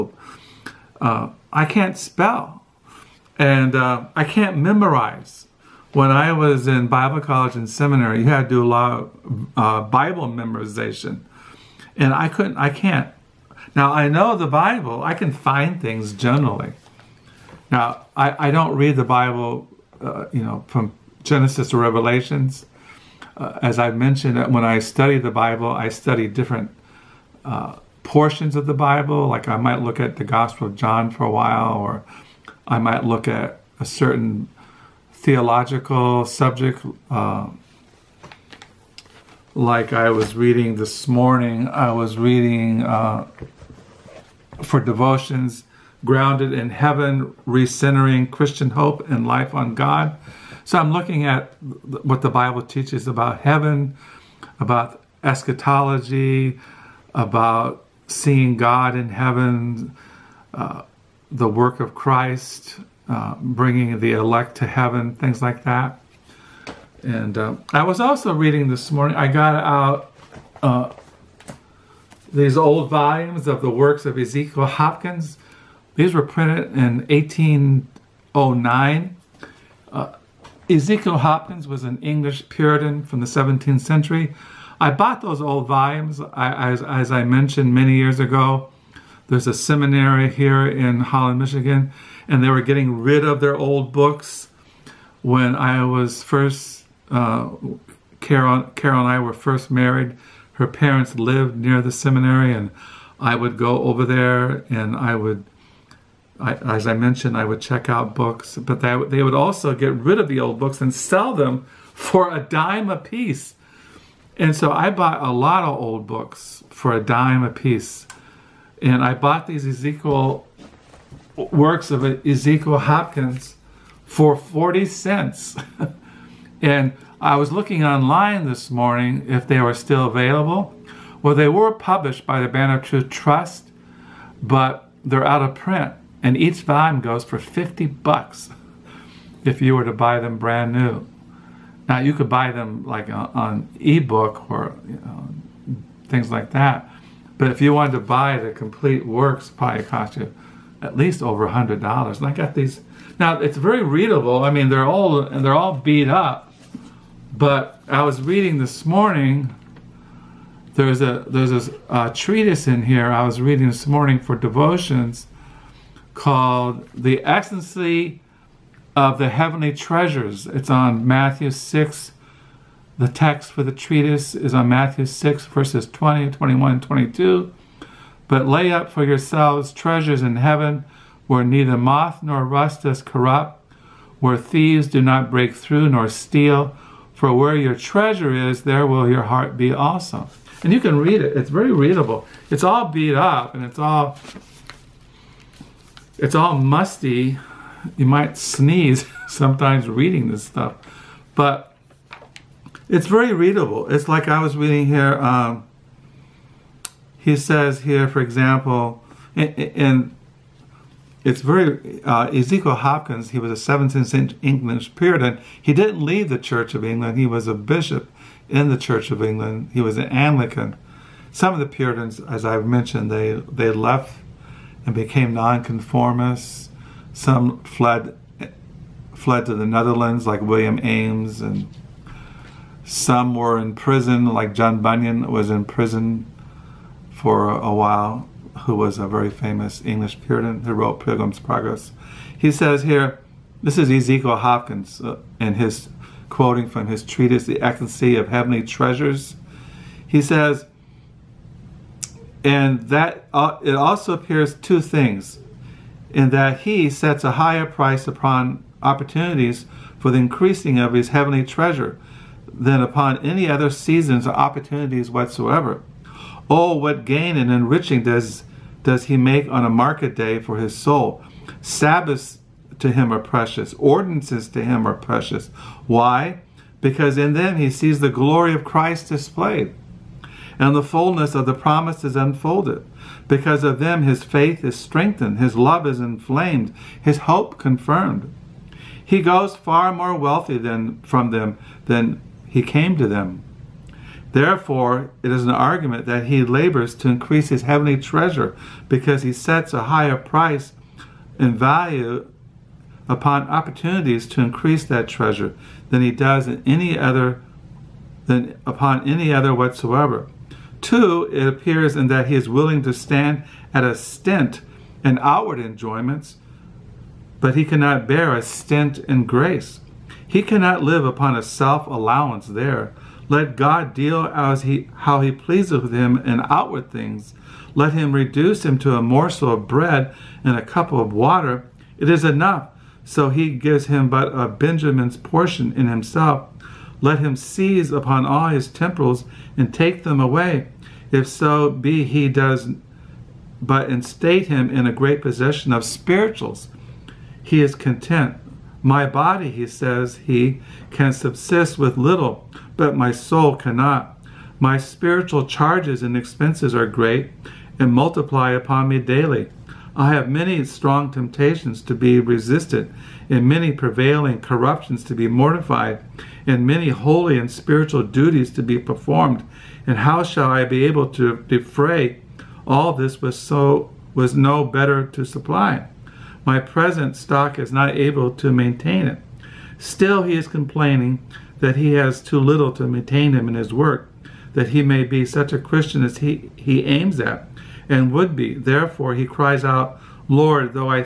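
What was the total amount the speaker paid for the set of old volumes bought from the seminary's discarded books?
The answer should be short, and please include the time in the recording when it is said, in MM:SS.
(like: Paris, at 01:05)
40 cents, at 02:04.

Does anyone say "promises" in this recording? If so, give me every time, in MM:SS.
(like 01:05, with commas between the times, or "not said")
04:41.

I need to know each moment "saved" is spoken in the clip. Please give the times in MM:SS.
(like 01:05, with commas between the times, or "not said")
not said.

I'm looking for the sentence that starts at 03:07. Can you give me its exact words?
For where your treasure is, there will your heart be also.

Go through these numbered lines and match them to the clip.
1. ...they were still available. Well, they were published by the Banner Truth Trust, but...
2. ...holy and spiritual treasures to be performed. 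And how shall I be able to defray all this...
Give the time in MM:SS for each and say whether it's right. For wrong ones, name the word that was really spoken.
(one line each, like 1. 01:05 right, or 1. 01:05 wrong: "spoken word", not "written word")
1. 02:09 right
2. 06:06 wrong: "duties", not "treasures".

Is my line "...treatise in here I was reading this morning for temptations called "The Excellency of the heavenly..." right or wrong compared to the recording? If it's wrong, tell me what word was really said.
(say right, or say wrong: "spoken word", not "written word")
wrong: "devotions", not "temptations".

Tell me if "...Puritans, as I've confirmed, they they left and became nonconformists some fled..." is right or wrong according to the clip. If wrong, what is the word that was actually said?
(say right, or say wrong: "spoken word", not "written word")
wrong: "mentioned", not "confirmed".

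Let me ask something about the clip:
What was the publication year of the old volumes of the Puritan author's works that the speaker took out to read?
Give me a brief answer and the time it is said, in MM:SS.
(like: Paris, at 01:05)
1809, at 01:17.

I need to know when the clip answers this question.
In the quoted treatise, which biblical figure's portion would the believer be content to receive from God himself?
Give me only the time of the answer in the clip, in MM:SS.
05:34.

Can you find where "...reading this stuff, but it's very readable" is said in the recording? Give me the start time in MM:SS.
03:19.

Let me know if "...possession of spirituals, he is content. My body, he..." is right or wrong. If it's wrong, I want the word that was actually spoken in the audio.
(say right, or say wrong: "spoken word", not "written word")
right.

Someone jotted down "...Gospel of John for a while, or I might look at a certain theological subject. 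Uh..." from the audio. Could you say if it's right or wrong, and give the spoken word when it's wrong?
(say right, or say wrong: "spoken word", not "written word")
right.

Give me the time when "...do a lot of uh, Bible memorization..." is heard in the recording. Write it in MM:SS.
00:08.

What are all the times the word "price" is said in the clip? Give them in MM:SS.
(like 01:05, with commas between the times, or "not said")
04:17, 05:00.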